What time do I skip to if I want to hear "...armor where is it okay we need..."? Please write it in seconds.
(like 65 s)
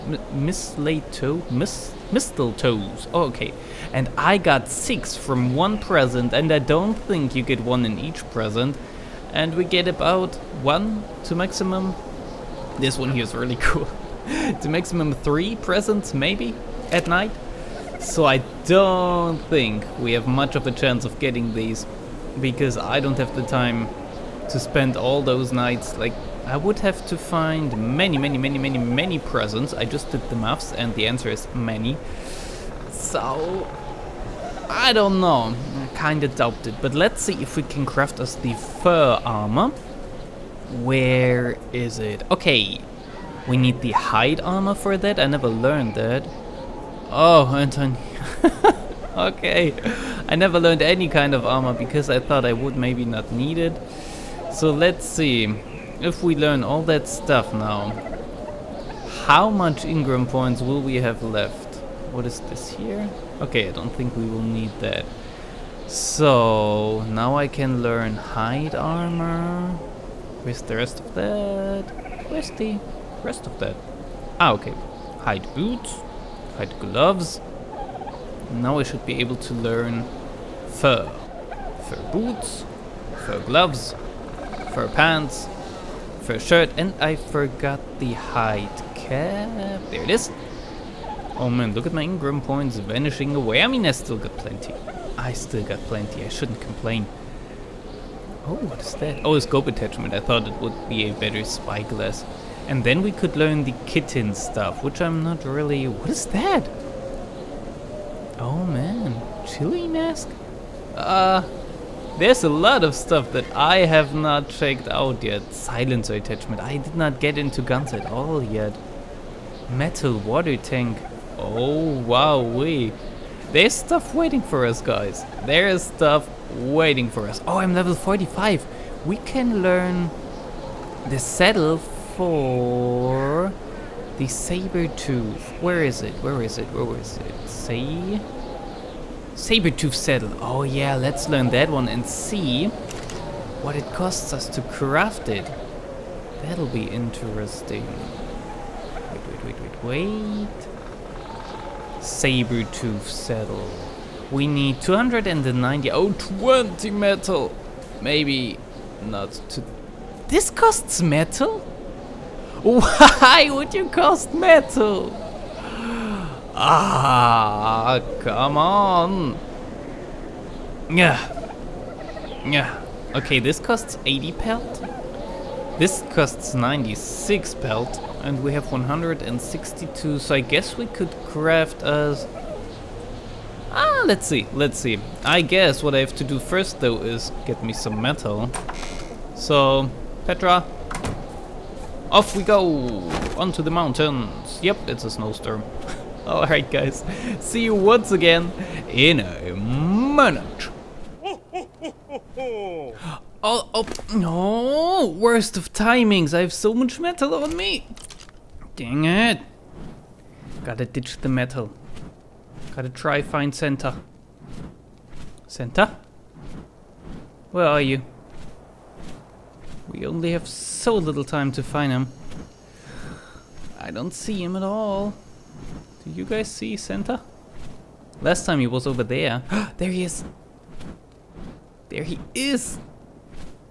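39 s.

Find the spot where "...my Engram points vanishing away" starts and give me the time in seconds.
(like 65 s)
91 s.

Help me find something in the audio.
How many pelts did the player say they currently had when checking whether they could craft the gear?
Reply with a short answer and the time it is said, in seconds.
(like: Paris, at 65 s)
162, at 178 s.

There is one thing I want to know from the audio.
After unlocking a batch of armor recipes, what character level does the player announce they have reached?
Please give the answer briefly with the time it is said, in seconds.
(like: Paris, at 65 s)
45, at 127 s.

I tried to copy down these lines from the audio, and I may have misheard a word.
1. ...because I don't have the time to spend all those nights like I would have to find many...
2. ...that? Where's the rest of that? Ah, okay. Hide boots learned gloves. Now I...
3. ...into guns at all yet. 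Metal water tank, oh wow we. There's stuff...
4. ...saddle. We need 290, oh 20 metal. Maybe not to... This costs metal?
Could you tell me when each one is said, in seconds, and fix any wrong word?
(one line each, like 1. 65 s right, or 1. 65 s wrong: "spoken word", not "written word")
1. 22 s right
2. 71 s wrong: "modified", not "learned"
3. 117 s right
4. 153 s right.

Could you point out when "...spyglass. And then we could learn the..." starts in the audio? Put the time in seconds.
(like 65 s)
101 s.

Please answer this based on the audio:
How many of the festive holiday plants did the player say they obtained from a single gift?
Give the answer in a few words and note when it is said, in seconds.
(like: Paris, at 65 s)
6, at 4 s.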